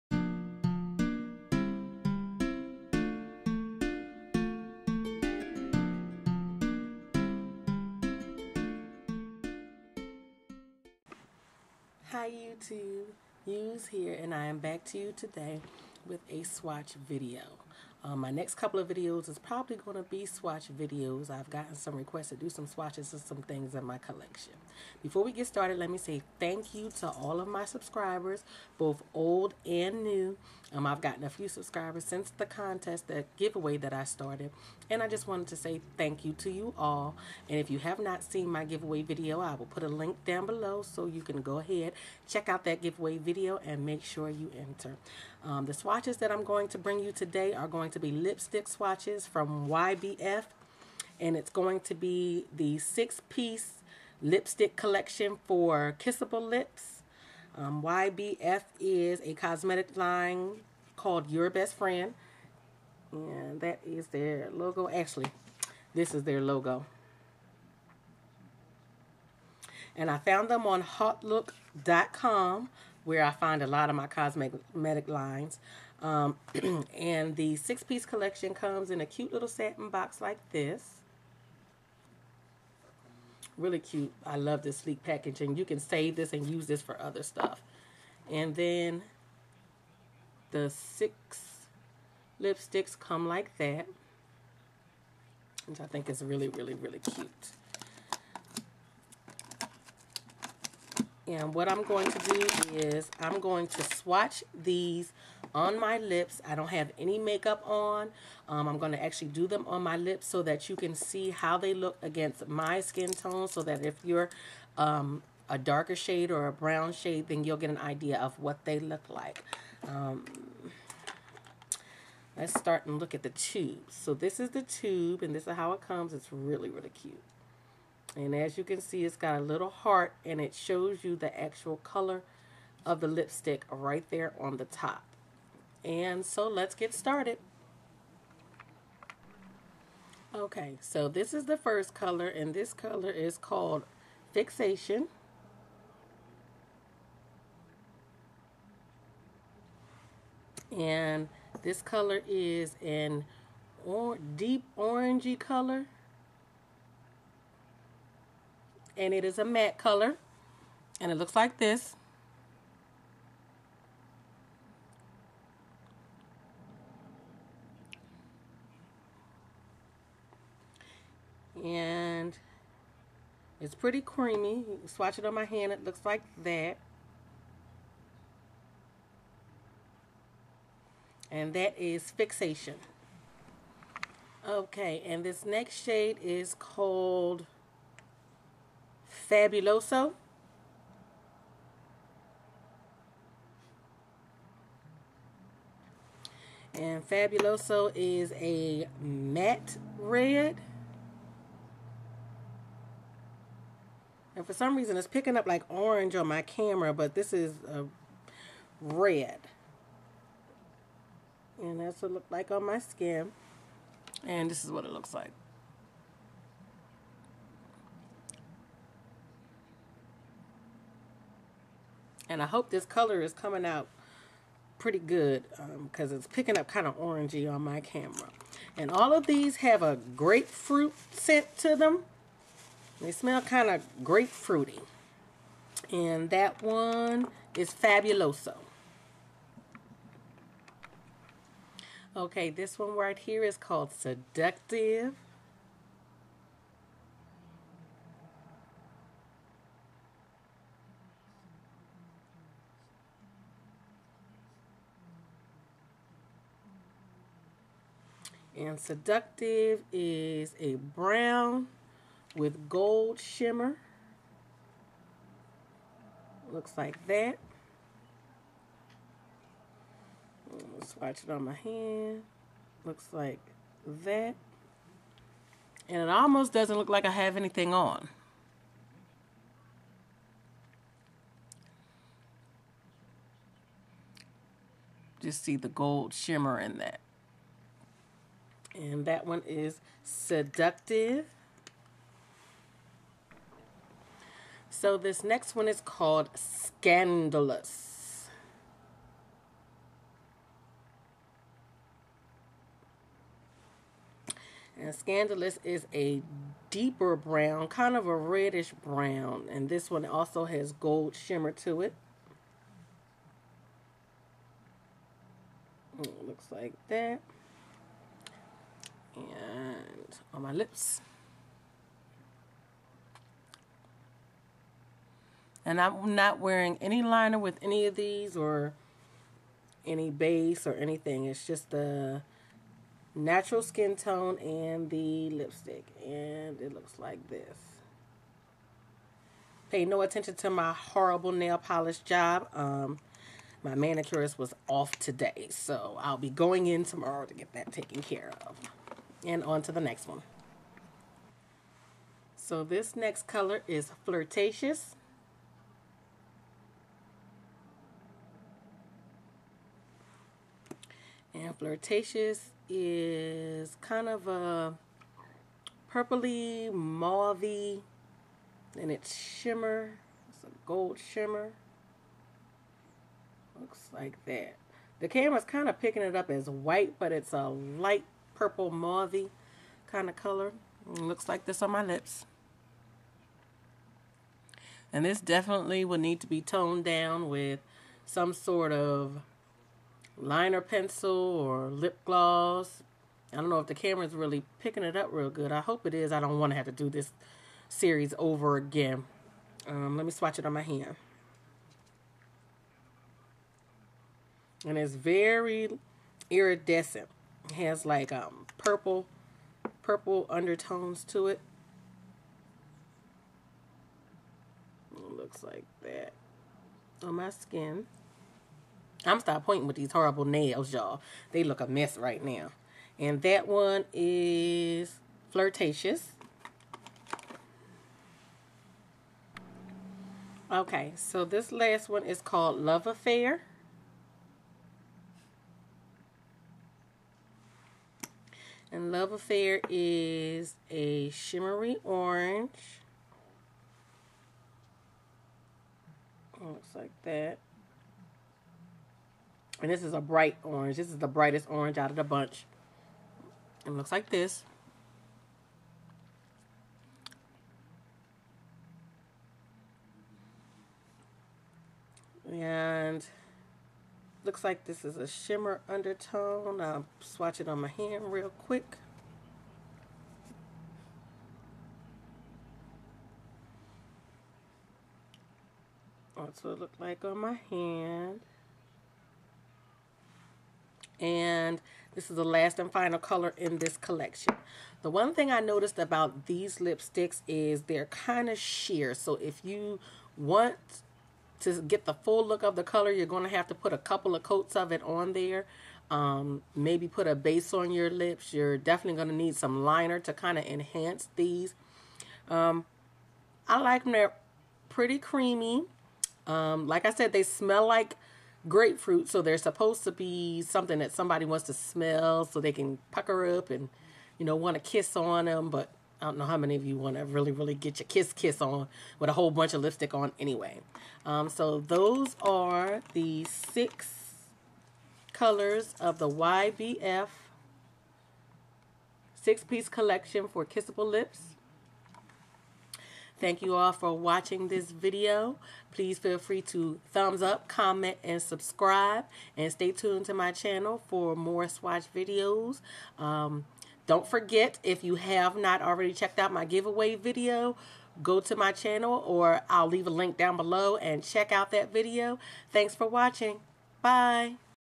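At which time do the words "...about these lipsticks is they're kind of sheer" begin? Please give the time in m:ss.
8:05.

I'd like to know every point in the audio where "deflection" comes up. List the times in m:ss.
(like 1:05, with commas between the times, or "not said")
not said.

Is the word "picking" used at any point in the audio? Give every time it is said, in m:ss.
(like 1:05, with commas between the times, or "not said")
3:25, 3:46, 6:15, 6:34.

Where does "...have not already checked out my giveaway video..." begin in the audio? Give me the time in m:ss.
9:04.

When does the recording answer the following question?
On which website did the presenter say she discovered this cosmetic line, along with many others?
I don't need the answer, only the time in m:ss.
1:10.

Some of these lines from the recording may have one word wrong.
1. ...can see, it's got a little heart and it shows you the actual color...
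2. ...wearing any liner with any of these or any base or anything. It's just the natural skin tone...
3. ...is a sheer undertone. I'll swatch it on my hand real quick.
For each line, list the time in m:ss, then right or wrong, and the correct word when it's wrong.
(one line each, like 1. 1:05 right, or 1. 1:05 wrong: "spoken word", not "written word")
1. 2:08 right
2. 5:26 right
3. 7:44 wrong: "shimmer", not "sheer".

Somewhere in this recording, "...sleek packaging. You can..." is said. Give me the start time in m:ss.
1:24.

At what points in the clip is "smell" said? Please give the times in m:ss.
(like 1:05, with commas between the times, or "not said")
3:53, 8:27, 8:31.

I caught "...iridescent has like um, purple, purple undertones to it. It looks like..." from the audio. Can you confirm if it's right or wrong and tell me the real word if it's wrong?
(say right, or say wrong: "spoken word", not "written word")
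right.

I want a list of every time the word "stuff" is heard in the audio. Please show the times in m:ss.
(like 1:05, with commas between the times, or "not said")
1:27.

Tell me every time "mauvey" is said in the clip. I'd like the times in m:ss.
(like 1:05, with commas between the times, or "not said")
6:06, 6:18.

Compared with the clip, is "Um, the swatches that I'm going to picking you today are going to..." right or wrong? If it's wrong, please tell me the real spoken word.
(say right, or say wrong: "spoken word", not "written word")
wrong: "bring", not "picking".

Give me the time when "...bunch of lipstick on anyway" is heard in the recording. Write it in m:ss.
8:39.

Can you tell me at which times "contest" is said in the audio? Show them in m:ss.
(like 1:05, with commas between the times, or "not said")
0:32.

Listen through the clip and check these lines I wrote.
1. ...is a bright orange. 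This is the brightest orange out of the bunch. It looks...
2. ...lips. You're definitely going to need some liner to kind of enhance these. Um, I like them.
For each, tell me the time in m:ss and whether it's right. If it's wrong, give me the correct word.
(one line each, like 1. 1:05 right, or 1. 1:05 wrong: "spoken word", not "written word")
1. 7:29 right
2. 8:17 right.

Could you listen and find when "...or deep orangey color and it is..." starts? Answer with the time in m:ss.
2:33.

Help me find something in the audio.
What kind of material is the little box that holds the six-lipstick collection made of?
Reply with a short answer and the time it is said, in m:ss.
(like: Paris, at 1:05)
Satin, at 1:19.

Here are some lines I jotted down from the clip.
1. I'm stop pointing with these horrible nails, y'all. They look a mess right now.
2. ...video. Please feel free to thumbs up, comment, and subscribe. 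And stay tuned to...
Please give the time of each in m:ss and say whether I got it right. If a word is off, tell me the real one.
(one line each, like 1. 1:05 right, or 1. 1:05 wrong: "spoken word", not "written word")
1. 6:59 right
2. 8:54 right.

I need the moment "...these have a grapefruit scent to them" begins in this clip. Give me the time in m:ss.
3:49.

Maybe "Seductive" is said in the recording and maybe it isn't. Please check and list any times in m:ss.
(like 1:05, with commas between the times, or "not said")
4:03, 4:18, 4:50.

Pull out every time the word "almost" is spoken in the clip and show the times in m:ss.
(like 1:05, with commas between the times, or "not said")
4:36.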